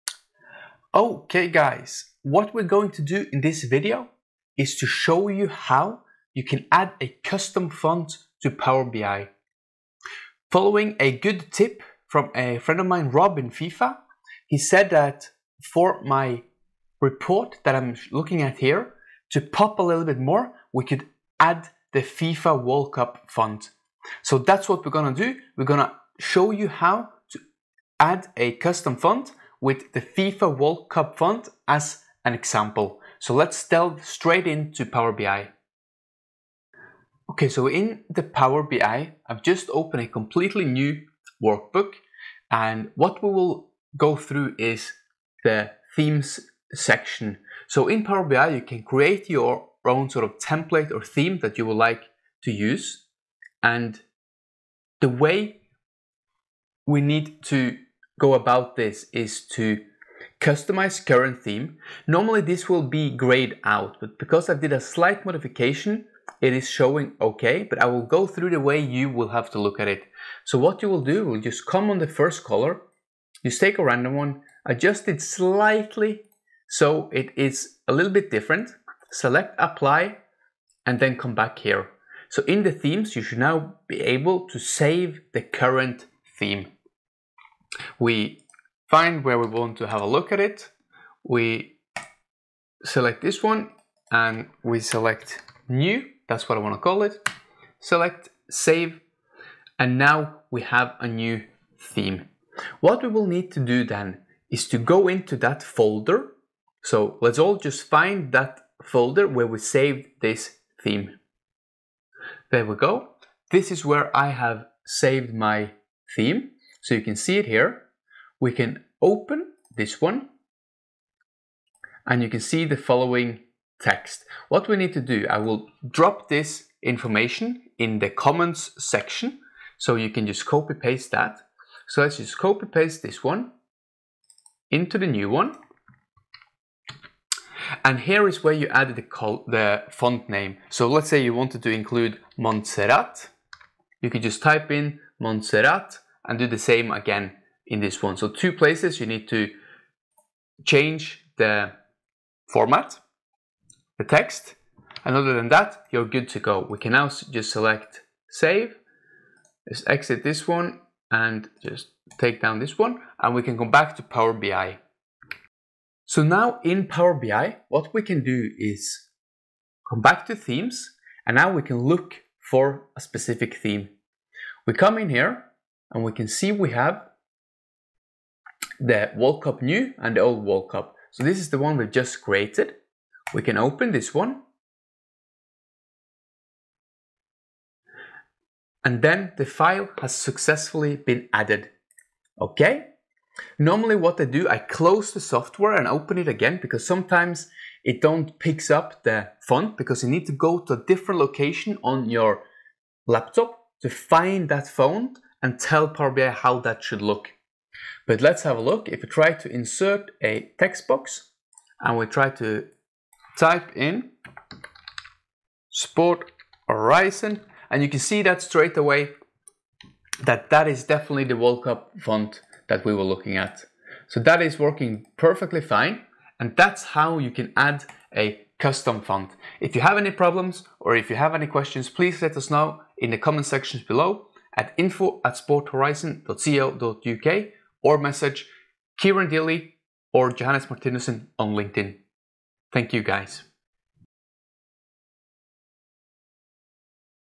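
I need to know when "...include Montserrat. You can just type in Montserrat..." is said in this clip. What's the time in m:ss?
2:21.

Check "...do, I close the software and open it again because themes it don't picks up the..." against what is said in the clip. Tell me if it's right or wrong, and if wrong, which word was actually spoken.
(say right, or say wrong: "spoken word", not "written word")
wrong: "sometimes", not "themes".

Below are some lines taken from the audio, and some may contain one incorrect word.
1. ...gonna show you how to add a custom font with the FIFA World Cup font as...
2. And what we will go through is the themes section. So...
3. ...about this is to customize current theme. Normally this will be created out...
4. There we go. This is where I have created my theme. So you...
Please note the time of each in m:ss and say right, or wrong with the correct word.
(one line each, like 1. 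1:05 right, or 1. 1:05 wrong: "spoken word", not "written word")
1. 0:25 right
2. 0:42 right
3. 0:58 wrong: "grayed", not "created"
4. 1:52 wrong: "saved", not "created".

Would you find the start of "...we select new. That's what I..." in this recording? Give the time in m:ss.
1:34.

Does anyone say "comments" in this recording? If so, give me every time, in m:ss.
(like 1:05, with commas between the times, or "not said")
2:08, 3:53.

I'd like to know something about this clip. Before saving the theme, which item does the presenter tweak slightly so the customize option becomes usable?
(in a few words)
The first color.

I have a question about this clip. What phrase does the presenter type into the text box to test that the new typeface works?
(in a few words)
Sport Horizon.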